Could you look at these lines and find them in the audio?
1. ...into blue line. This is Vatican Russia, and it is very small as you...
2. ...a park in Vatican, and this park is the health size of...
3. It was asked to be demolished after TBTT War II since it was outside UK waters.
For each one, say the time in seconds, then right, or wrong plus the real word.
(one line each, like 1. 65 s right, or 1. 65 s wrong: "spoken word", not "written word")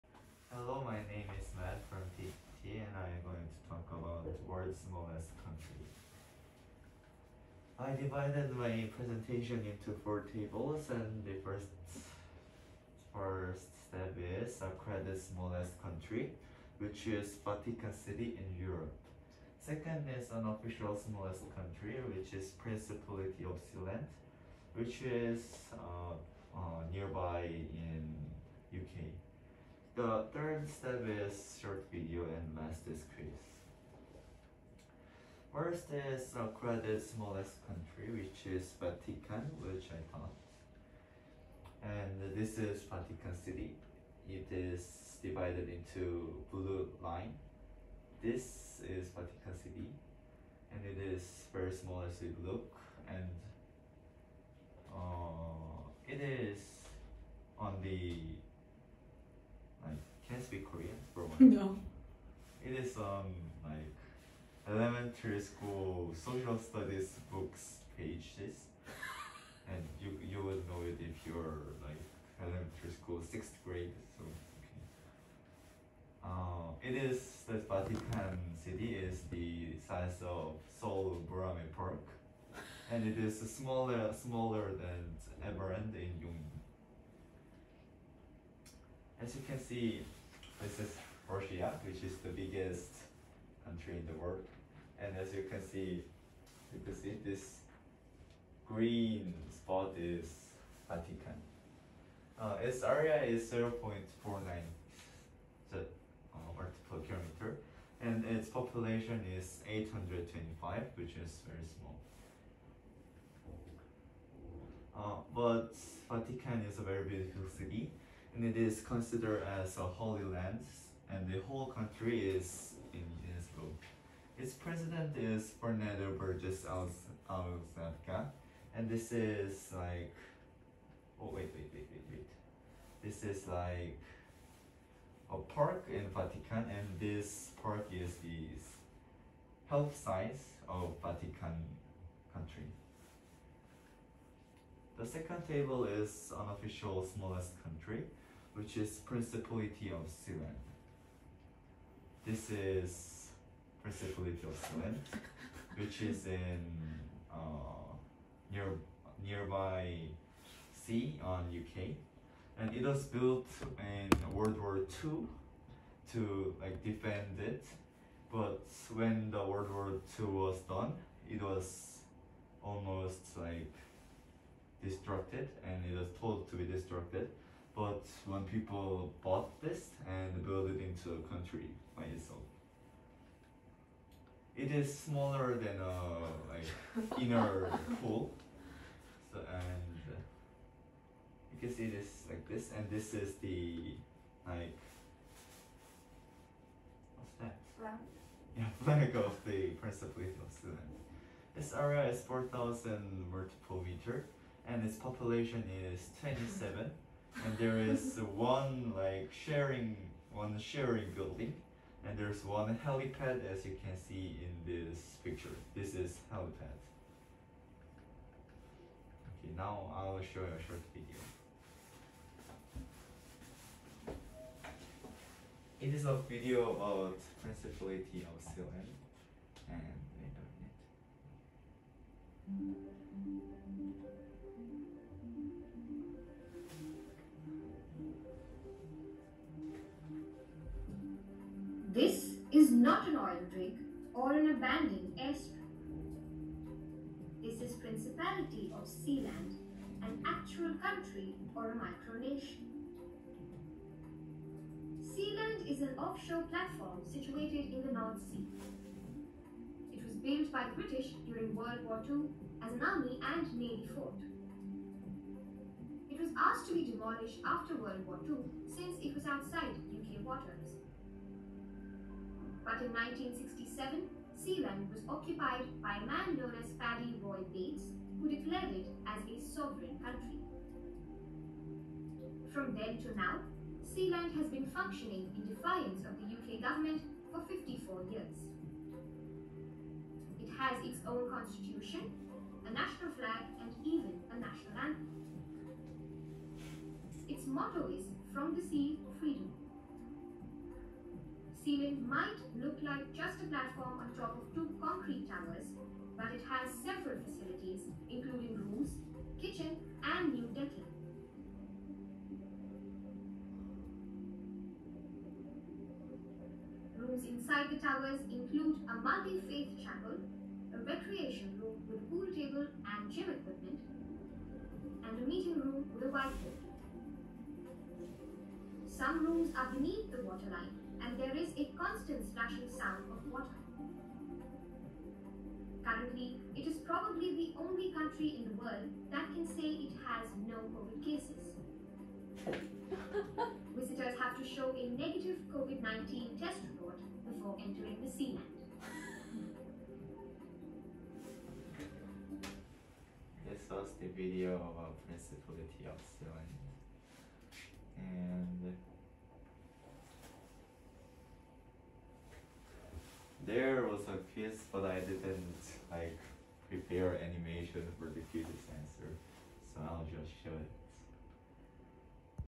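1. 45 s wrong: "City", not "Russia"
2. 135 s right
3. 266 s wrong: "World", not "TBTT".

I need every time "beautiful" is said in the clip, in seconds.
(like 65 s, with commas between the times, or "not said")
117 s.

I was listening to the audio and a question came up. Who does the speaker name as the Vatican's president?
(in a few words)
Fernando Vérgez Alexandra.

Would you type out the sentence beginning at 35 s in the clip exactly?
First is credit smallest country, which is Vatican, which I taught.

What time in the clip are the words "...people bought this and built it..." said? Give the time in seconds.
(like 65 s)
178 s.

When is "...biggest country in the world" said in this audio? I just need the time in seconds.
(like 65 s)
92 s.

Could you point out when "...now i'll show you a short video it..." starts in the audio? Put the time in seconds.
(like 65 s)
219 s.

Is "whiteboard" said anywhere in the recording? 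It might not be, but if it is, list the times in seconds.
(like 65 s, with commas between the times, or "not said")
326 s.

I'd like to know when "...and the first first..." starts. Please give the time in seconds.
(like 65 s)
10 s.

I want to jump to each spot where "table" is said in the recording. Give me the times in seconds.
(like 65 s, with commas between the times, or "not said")
10 s, 145 s, 322 s.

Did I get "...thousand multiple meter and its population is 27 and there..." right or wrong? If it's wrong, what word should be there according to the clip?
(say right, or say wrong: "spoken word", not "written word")
right.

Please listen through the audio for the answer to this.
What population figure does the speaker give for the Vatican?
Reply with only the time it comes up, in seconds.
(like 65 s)
109 s.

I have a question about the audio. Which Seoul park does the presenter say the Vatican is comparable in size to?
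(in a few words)
Boramae Park.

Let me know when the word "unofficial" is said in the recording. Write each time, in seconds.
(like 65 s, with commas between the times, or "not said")
20 s, 146 s.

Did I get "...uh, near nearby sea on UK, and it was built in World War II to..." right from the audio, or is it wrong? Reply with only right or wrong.
right.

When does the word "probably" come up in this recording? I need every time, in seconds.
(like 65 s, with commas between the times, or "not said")
336 s.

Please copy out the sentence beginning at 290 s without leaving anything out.
It has its own constitution, a national flag and even a national anthem.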